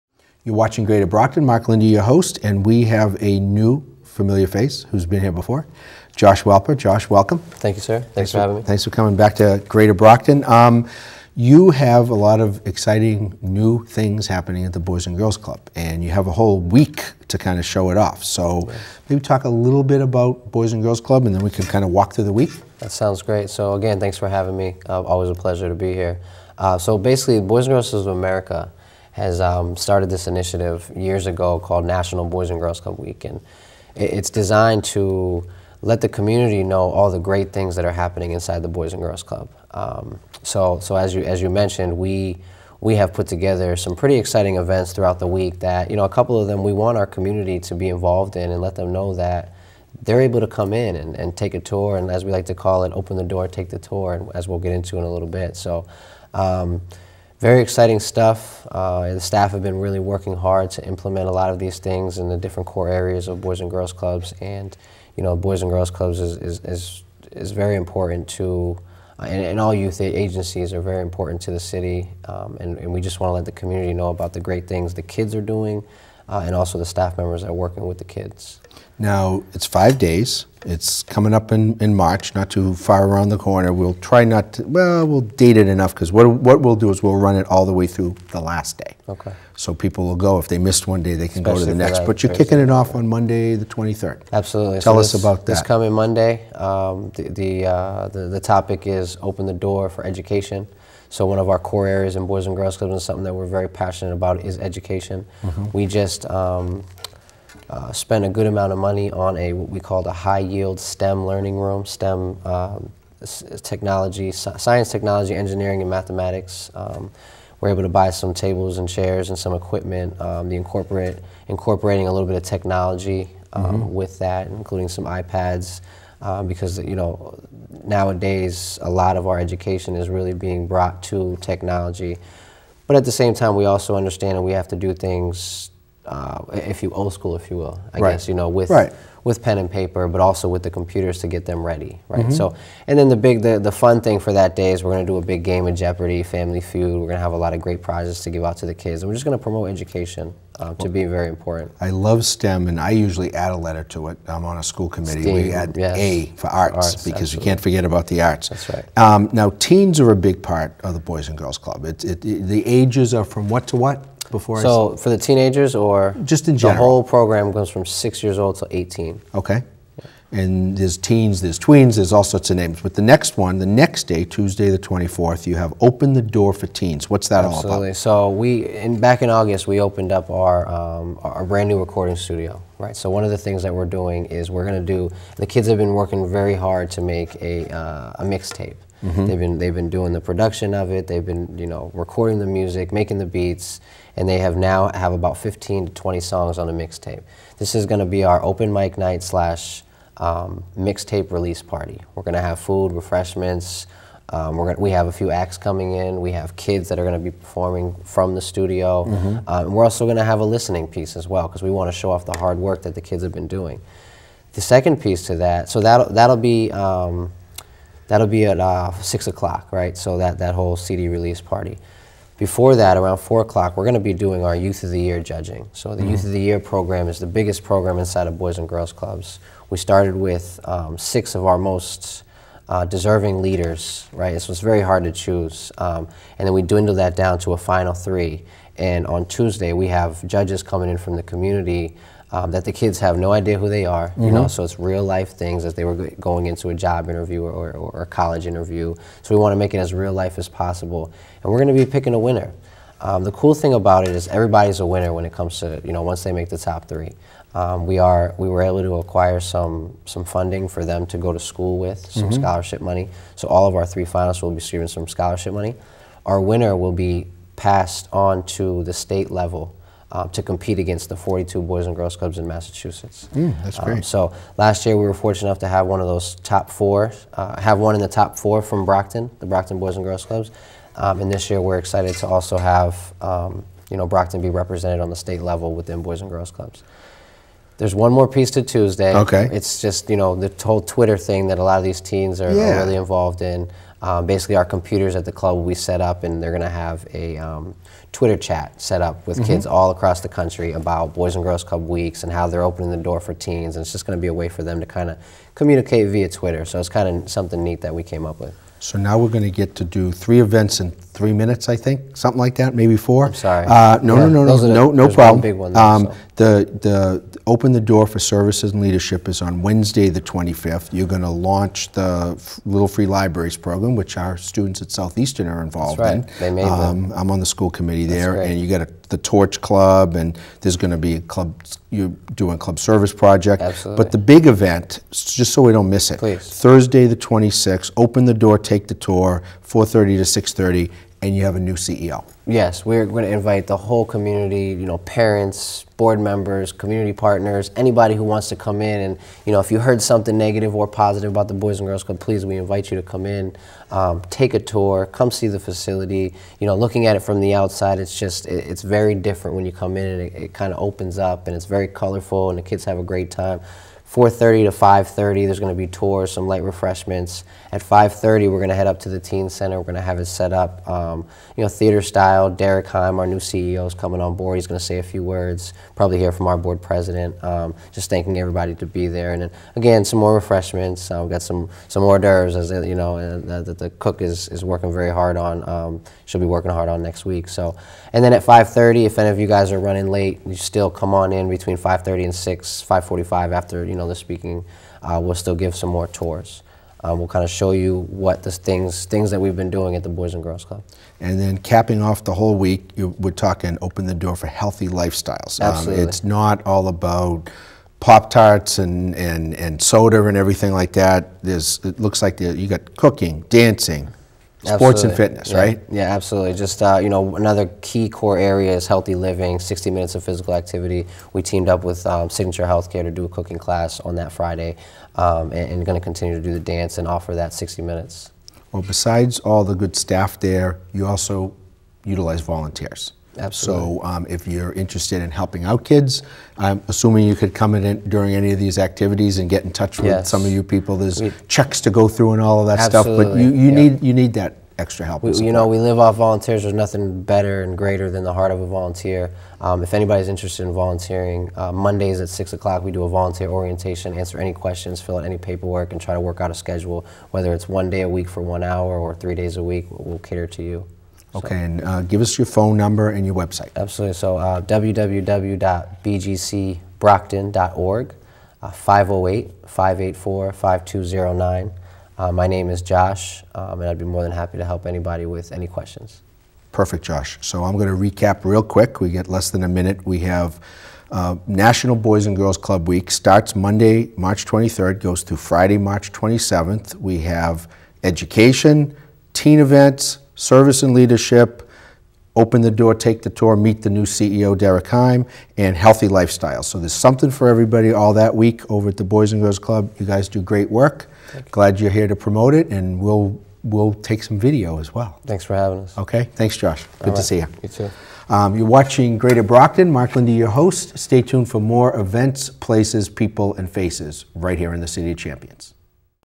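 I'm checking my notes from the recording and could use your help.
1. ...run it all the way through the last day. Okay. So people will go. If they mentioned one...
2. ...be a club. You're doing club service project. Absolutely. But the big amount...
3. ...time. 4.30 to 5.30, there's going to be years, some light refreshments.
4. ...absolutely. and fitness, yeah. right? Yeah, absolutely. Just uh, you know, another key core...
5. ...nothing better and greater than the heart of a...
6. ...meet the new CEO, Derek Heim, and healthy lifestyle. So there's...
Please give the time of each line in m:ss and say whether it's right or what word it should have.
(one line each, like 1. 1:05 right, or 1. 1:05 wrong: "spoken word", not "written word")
1. 1:27 wrong: "missed", not "mentioned"
2. 5:30 wrong: "event", not "amount"
3. 6:03 wrong: "tours", not "years"
4. 6:55 right
5. 7:26 right
6. 8:13 right.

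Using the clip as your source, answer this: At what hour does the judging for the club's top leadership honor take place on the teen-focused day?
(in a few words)
4 o'clock.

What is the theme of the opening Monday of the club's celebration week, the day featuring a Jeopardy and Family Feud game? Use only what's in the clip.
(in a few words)
Open the Door for Education.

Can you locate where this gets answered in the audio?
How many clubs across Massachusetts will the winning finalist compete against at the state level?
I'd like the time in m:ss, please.
4:31.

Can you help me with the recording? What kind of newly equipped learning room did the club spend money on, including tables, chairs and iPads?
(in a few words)
High yield STEM learning room.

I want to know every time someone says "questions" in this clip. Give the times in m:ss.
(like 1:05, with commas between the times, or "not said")
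7:34, 7:55.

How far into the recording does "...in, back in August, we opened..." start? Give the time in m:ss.
2:58.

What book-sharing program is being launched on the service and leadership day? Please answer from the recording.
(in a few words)
Little Free Libraries.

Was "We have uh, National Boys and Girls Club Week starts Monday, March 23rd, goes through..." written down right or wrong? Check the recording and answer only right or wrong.
right.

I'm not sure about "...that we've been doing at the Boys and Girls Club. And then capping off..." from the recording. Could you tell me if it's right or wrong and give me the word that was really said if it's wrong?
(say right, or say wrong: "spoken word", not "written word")
right.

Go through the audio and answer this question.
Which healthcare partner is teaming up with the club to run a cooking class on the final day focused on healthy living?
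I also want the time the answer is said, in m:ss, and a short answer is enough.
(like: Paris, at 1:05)
Signature Healthcare, at 7:02.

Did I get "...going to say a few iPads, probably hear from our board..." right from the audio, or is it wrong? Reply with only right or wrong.
wrong.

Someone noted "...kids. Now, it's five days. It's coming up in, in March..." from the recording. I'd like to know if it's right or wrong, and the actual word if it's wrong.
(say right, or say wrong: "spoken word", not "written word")
right.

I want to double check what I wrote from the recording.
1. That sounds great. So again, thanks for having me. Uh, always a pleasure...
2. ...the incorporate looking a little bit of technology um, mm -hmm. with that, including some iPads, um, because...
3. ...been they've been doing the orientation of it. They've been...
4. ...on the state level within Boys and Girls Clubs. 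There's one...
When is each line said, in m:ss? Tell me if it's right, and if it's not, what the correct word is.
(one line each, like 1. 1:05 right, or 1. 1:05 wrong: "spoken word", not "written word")
1. 0:22 right
2. 2:00 wrong: "incorporating", not "looking"
3. 3:09 wrong: "production", not "orientation"
4. 4:44 right.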